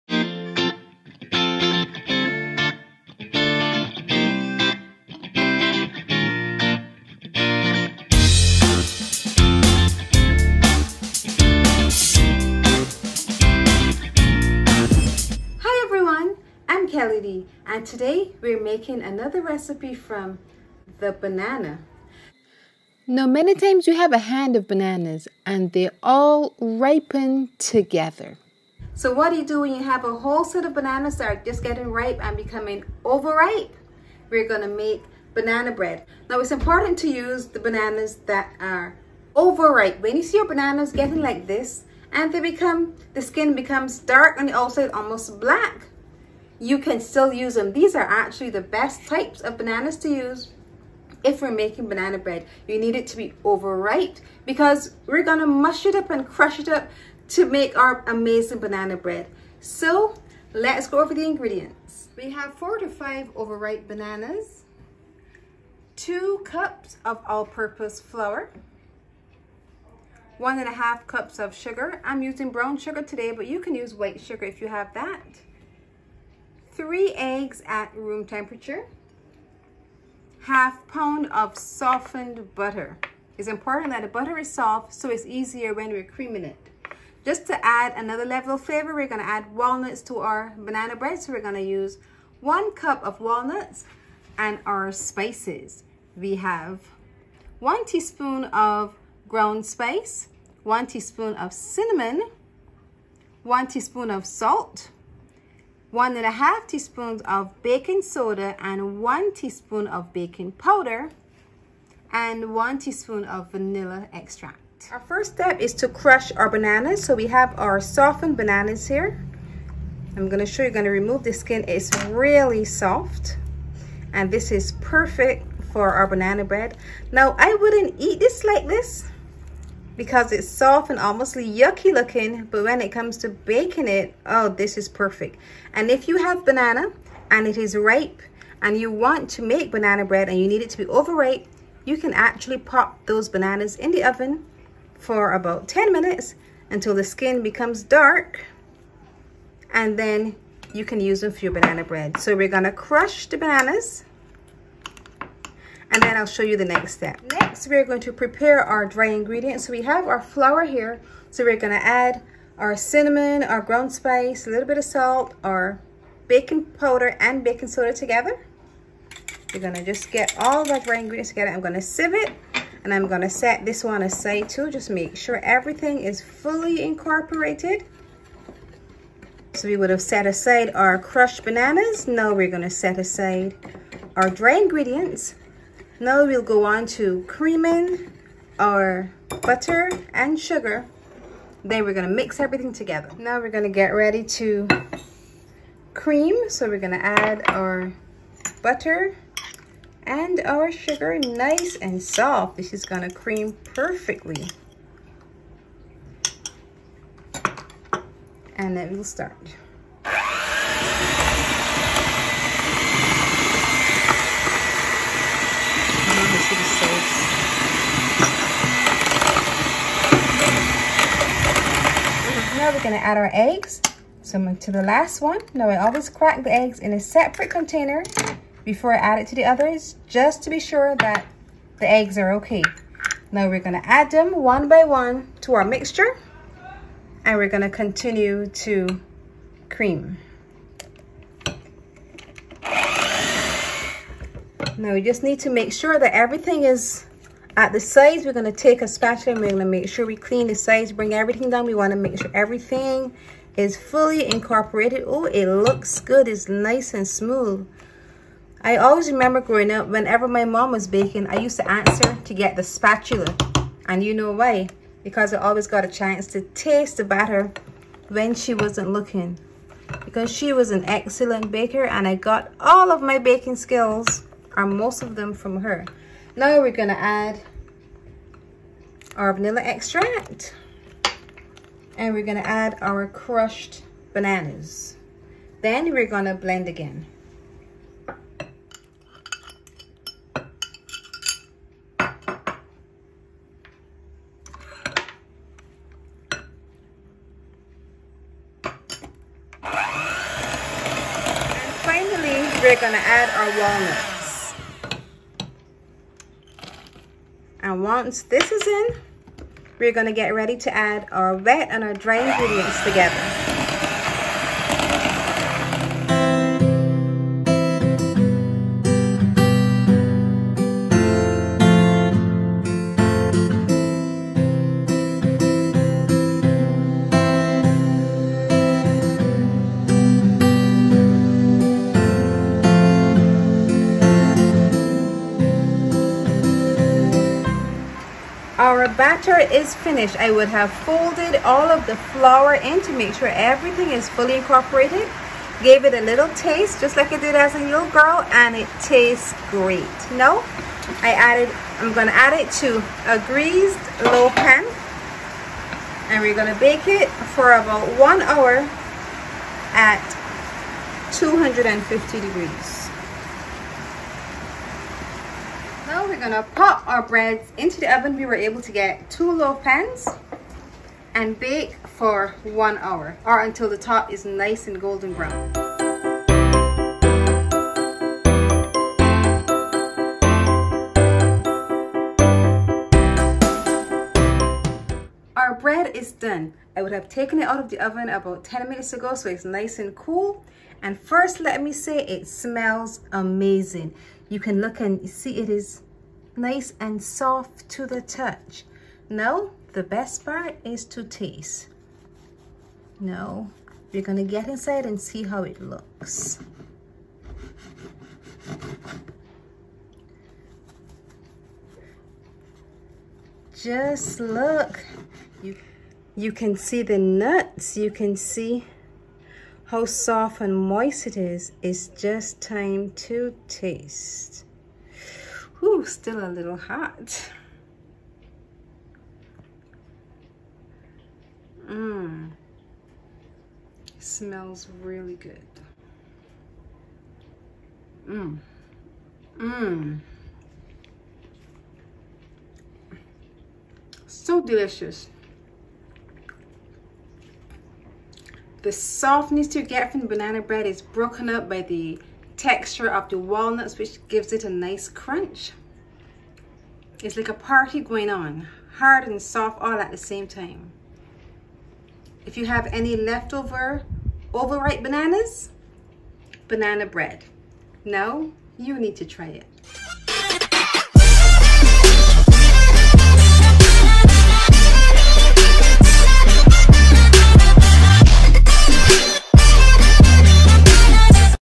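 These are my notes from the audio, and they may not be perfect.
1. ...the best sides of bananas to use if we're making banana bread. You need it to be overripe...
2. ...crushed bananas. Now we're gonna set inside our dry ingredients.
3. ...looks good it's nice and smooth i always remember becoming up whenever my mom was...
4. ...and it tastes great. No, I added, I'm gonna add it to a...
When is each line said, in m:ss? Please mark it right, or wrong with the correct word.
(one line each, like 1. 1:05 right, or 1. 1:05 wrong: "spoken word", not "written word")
1. 0:48 wrong: "types", not "sides"
2. 3:00 wrong: "aside", not "inside"
3. 4:15 wrong: "growing", not "becoming"
4. 5:48 right.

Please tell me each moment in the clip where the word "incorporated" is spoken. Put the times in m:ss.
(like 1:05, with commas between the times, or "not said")
2:56, 4:14, 5:44.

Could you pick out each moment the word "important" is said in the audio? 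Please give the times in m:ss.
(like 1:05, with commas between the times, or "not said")
0:36, 1:23.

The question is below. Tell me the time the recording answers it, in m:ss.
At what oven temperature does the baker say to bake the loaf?
6:01.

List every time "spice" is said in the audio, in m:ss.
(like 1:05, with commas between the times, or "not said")
1:34, 1:39, 2:43.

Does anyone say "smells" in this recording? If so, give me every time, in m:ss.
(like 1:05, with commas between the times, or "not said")
6:32, 7:13.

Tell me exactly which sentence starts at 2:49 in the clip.
We're gonna just get all the dry ingredients together.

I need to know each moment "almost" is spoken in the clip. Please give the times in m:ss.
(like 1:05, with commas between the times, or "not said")
0:44, 2:10.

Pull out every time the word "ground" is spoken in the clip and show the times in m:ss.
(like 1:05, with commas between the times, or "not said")
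1:39, 2:43.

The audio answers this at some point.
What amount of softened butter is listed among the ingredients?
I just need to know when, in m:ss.
1:20.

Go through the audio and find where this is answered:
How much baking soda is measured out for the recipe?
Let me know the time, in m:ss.
1:45.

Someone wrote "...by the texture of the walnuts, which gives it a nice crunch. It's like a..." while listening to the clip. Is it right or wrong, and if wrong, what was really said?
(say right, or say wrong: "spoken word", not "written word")
right.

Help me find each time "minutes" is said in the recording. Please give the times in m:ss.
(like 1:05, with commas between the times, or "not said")
2:25, 6:28.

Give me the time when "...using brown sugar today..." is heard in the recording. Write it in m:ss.
1:12.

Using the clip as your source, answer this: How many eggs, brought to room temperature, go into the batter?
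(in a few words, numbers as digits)
3.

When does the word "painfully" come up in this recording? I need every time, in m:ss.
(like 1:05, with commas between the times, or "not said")
not said.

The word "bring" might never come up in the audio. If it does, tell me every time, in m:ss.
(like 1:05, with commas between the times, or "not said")
4:10.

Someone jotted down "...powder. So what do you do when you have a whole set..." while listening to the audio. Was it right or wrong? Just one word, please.
wrong.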